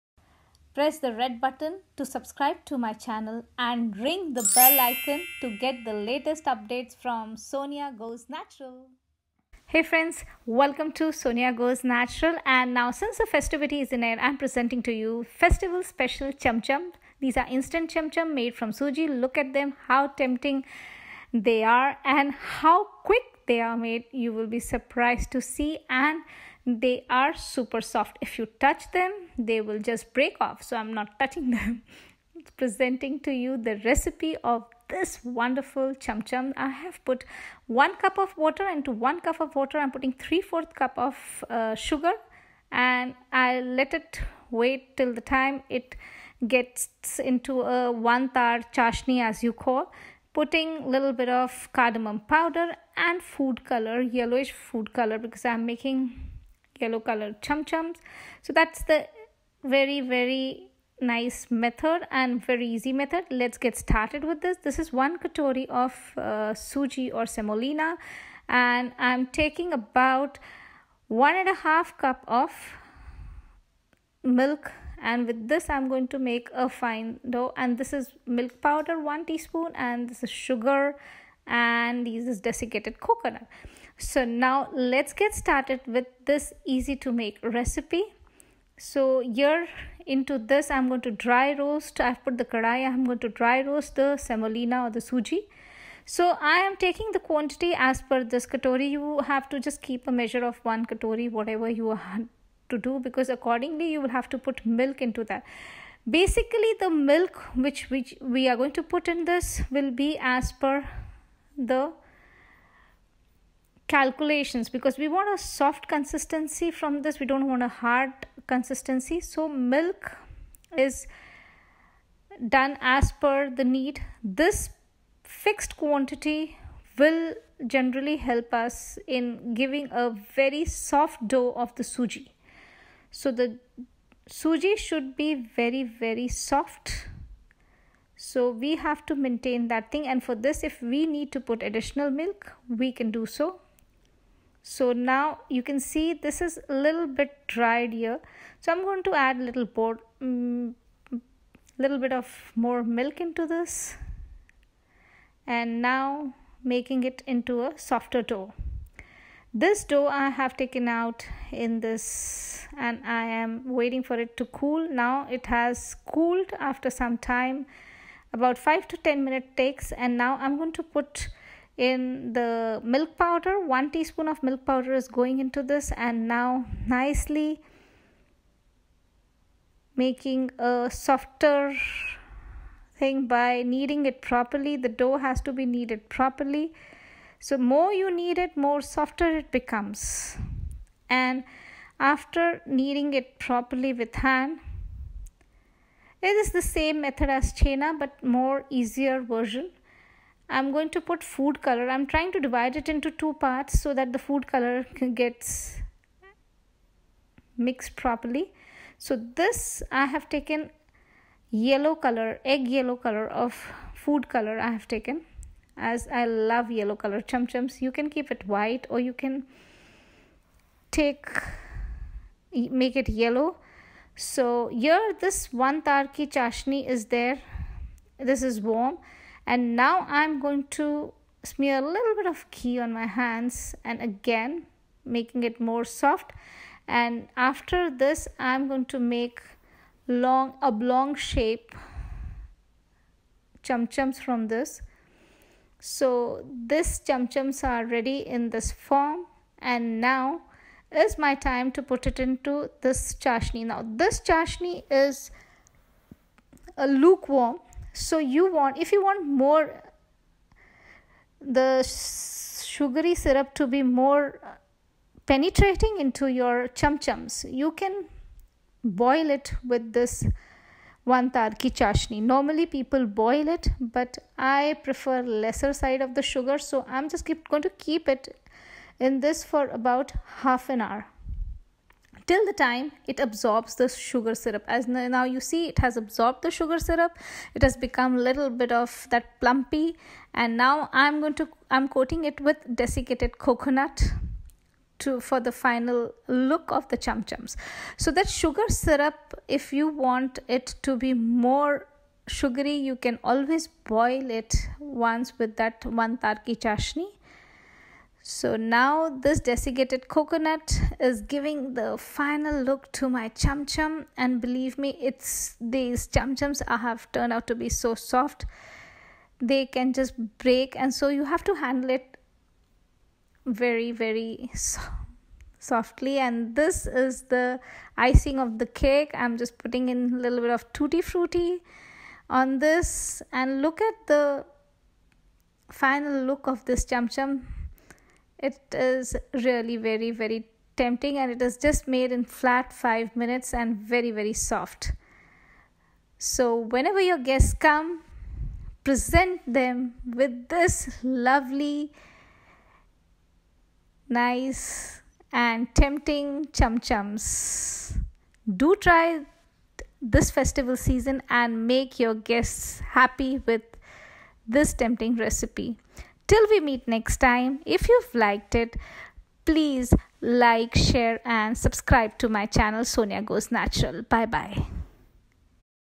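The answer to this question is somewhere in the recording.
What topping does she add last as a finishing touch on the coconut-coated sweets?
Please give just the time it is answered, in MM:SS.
05:30.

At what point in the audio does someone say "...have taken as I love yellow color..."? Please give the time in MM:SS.
03:34.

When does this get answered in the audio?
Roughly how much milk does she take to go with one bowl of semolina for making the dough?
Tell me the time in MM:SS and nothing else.
01:11.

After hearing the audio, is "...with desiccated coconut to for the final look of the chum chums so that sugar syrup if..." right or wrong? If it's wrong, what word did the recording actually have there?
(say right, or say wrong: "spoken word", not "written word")
right.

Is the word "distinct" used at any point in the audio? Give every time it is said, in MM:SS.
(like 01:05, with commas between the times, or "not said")
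not said.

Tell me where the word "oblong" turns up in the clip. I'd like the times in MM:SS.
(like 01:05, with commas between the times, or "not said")
04:00.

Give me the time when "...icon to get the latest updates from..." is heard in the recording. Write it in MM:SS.
00:04.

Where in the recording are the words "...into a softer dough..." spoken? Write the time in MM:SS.
02:37.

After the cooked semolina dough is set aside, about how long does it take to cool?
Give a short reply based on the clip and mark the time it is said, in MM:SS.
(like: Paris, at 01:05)
5 to 10 minutes, at 02:48.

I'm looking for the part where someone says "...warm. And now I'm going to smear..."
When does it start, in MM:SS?
03:48.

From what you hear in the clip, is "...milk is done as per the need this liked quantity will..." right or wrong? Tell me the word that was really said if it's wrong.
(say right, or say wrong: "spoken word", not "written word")
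wrong: "fixed", not "liked".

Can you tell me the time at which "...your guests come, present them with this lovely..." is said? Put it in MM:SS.
05:47.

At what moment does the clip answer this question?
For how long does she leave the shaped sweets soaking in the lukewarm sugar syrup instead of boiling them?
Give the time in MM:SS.
04:40.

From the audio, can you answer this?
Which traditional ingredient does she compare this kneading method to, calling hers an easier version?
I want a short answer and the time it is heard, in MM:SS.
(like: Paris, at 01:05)
Chena, at 03:17.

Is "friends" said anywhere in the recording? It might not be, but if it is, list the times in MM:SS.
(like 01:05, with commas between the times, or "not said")
00:09.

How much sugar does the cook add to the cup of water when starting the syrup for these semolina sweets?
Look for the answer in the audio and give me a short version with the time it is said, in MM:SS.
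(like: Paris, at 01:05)
3/4 cup, at 00:40.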